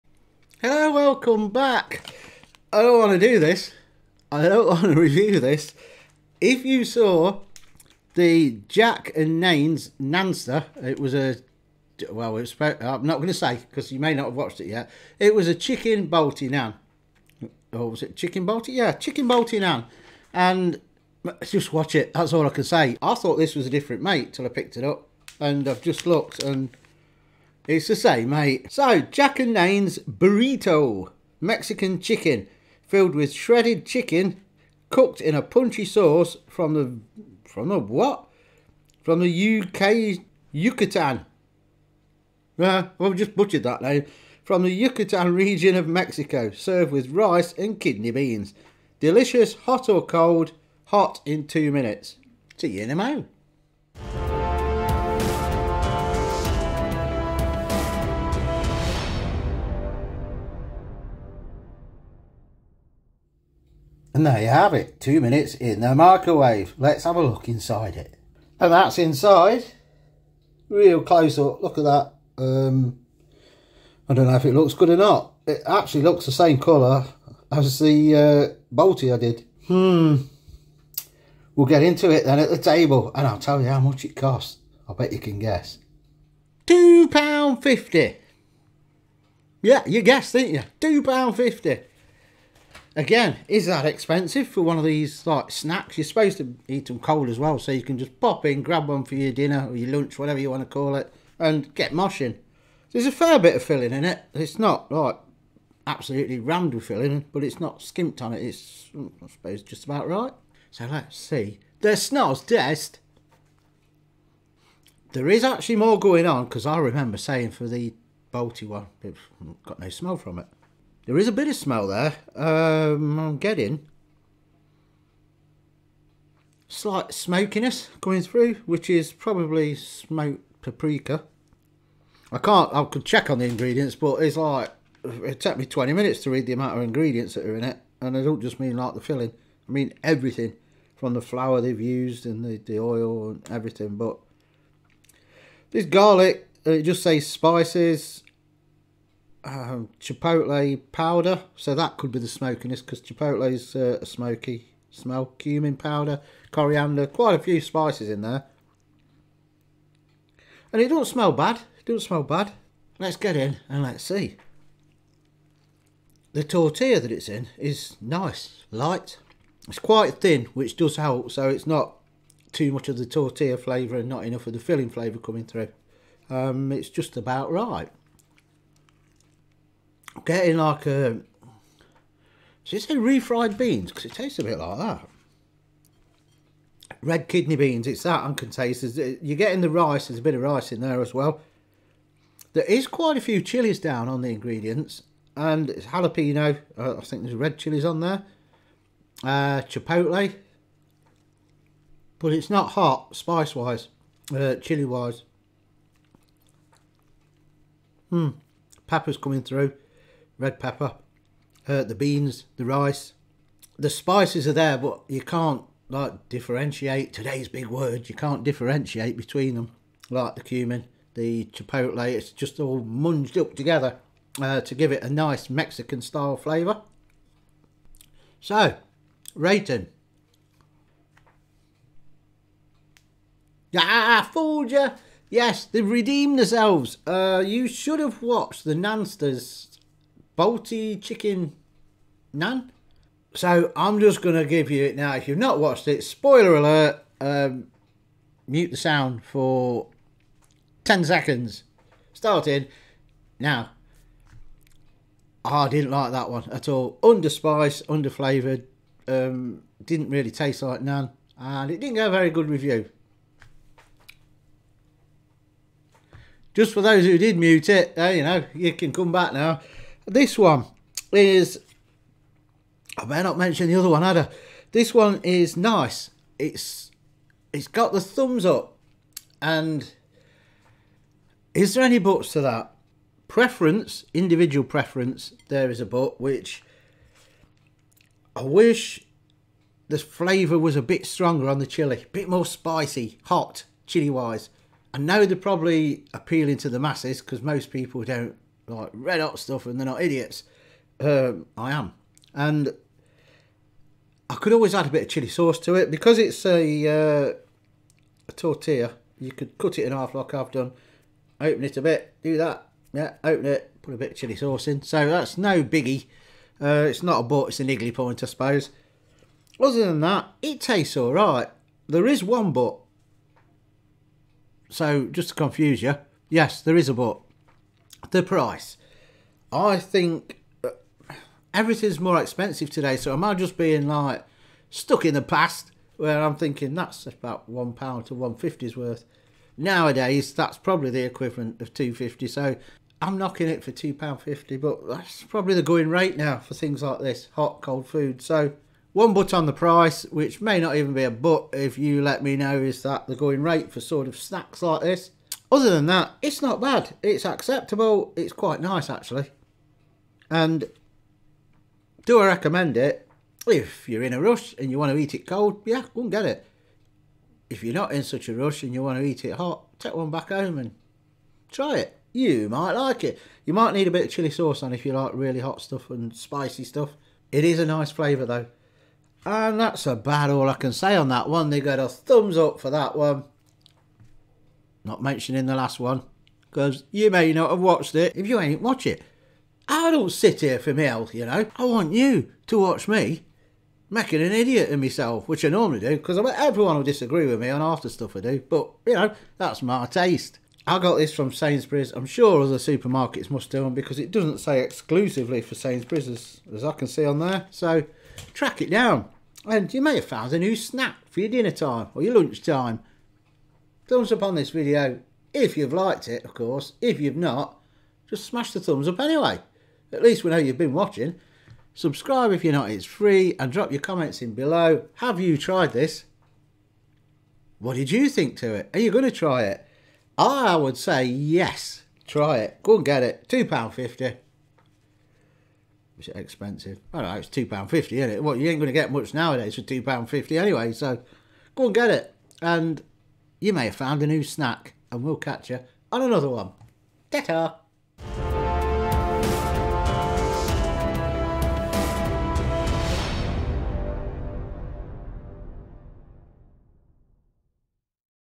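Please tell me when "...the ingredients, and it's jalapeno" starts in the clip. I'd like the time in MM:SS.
03:14.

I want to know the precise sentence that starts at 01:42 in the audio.
There's a fair bit of filling in it.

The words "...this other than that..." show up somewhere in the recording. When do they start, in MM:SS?
05:54.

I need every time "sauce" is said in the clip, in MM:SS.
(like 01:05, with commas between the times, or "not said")
00:35, 05:05, 05:14, 06:14.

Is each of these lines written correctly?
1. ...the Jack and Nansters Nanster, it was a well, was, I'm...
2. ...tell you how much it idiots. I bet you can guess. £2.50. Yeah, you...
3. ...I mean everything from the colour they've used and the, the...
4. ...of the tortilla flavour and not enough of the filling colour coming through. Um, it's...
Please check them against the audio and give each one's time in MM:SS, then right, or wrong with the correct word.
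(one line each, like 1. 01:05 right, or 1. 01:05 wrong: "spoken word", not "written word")
1. 00:08 wrong: "Nayns", not "Nansters"
2. 01:23 wrong: "costs", not "idiots"
3. 02:19 wrong: "flour", not "colour"
4. 02:52 wrong: "flavour", not "colour".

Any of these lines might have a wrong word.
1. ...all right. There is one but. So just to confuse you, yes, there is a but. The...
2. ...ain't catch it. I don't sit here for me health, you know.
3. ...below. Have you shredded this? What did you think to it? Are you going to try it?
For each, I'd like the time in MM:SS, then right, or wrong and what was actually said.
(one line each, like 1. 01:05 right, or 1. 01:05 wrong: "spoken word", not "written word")
1. 05:20 right
2. 06:28 wrong: "watch", not "catch"
3. 07:04 wrong: "tried", not "shredded".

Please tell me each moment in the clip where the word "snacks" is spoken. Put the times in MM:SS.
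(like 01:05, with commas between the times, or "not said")
01:35, 05:54, 06:50, 07:24.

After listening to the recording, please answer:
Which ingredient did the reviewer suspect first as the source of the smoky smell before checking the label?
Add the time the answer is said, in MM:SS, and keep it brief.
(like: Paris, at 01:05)
smoked paprika, at 02:09.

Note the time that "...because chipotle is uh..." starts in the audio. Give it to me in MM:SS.
02:32.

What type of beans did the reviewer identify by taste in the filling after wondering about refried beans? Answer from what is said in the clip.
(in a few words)
red kidney beans.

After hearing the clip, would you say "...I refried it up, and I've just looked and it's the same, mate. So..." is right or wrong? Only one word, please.
wrong.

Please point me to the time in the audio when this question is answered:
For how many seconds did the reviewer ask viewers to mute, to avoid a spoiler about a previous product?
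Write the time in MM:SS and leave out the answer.
04:10.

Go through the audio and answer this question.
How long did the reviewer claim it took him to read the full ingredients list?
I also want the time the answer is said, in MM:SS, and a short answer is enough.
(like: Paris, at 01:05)
20 minutes, at 02:15.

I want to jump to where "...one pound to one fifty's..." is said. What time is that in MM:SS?
05:37.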